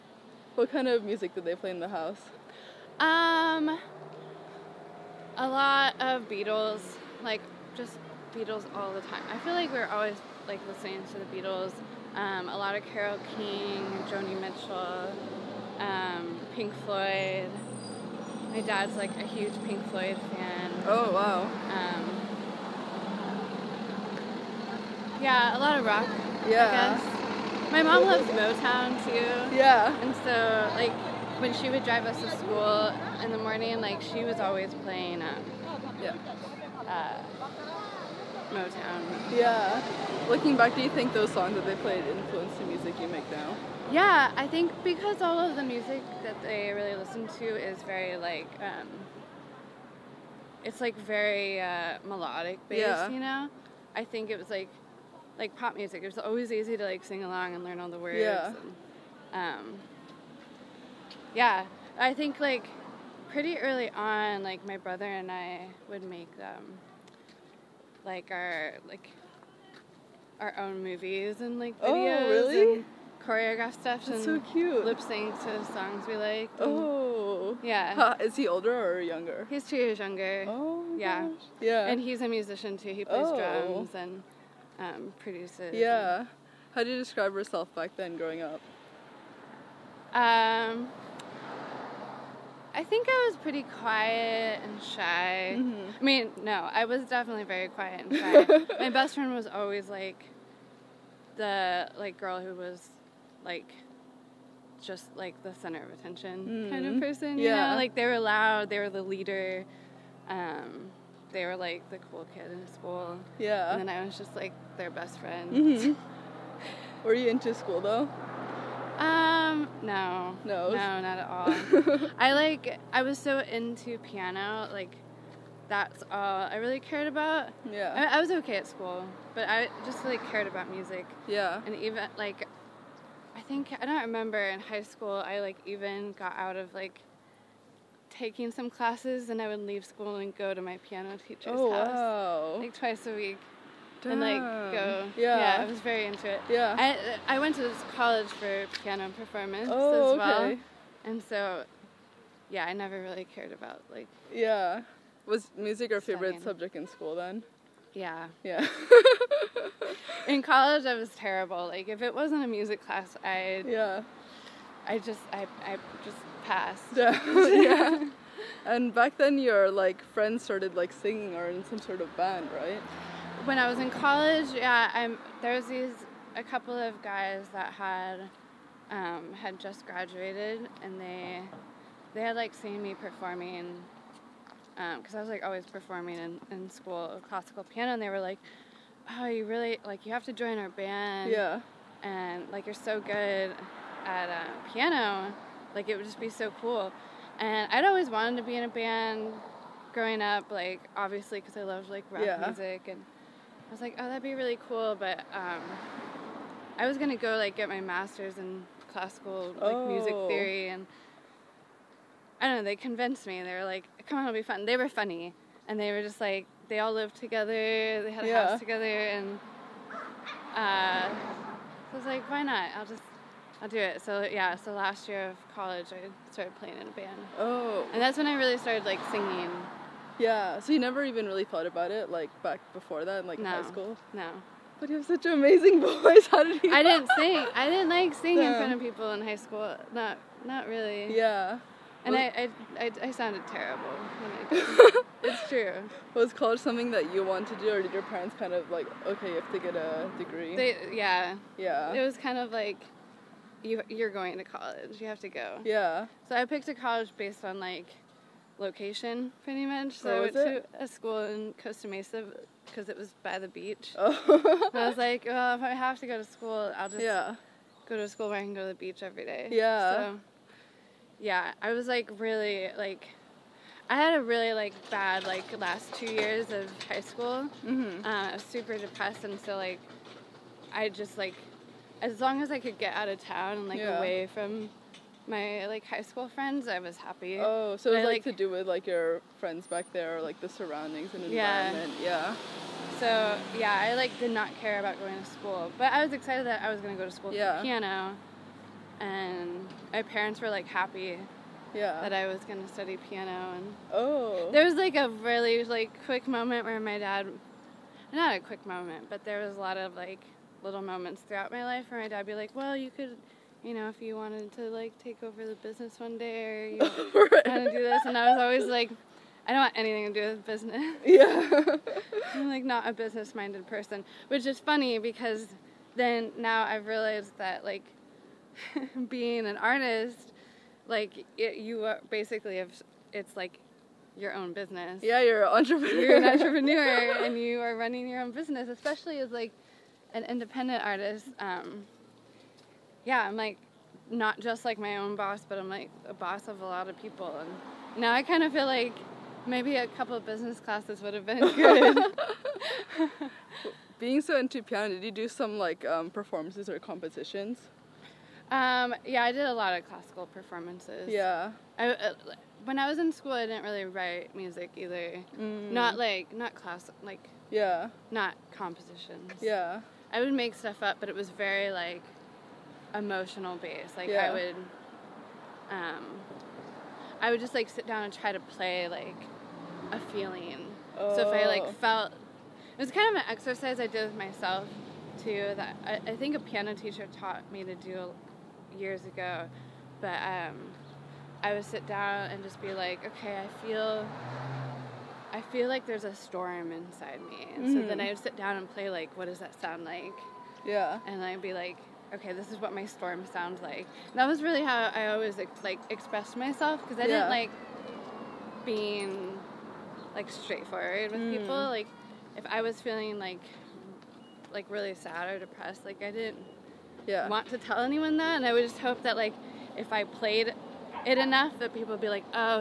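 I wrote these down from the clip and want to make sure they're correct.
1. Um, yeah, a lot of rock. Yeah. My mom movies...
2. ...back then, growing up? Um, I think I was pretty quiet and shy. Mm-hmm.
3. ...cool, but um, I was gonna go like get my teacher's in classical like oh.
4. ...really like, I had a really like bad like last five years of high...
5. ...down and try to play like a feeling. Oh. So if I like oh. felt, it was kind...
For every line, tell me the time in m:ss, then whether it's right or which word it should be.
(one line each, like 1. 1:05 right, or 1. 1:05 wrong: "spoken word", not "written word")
1. 0:21 wrong: "loves", not "movies"
2. 1:27 right
3. 3:24 wrong: "master", not "teacher"
4. 4:32 wrong: "two", not "five"
5. 6:17 right.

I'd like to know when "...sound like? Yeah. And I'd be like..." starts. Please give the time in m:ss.
6:39.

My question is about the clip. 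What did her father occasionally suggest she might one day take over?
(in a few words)
the business.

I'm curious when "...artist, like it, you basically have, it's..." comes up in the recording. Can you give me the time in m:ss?
5:29.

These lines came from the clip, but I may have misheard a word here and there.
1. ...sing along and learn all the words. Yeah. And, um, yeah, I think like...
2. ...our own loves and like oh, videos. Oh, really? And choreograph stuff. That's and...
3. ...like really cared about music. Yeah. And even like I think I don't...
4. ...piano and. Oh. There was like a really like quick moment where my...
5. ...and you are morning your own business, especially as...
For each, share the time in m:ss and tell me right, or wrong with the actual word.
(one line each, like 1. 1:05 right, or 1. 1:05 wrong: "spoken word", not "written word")
1. 0:57 right
2. 1:10 wrong: "movies", not "loves"
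3. 2:10 right
4. 5:02 right
5. 5:37 wrong: "running", not "morning".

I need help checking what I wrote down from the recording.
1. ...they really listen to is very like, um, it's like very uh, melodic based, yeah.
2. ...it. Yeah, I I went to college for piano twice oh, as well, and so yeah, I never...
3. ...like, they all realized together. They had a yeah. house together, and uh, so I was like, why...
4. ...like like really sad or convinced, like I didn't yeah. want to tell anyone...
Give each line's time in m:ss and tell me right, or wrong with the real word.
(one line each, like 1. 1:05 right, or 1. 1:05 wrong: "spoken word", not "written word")
1. 0:46 right
2. 2:26 wrong: "performance", not "twice"
3. 3:36 wrong: "lived", not "realized"
4. 6:53 wrong: "depressed", not "convinced".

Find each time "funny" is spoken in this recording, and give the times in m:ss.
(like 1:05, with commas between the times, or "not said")
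3:34, 5:24.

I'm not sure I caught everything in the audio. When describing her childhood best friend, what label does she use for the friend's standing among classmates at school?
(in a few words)
the cool kid.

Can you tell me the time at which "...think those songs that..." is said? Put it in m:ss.
0:40.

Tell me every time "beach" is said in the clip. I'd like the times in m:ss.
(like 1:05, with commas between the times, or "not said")
4:23, 4:28.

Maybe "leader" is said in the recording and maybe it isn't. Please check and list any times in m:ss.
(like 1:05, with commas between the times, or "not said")
1:49.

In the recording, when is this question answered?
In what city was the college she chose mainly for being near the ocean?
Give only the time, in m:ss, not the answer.
4:21.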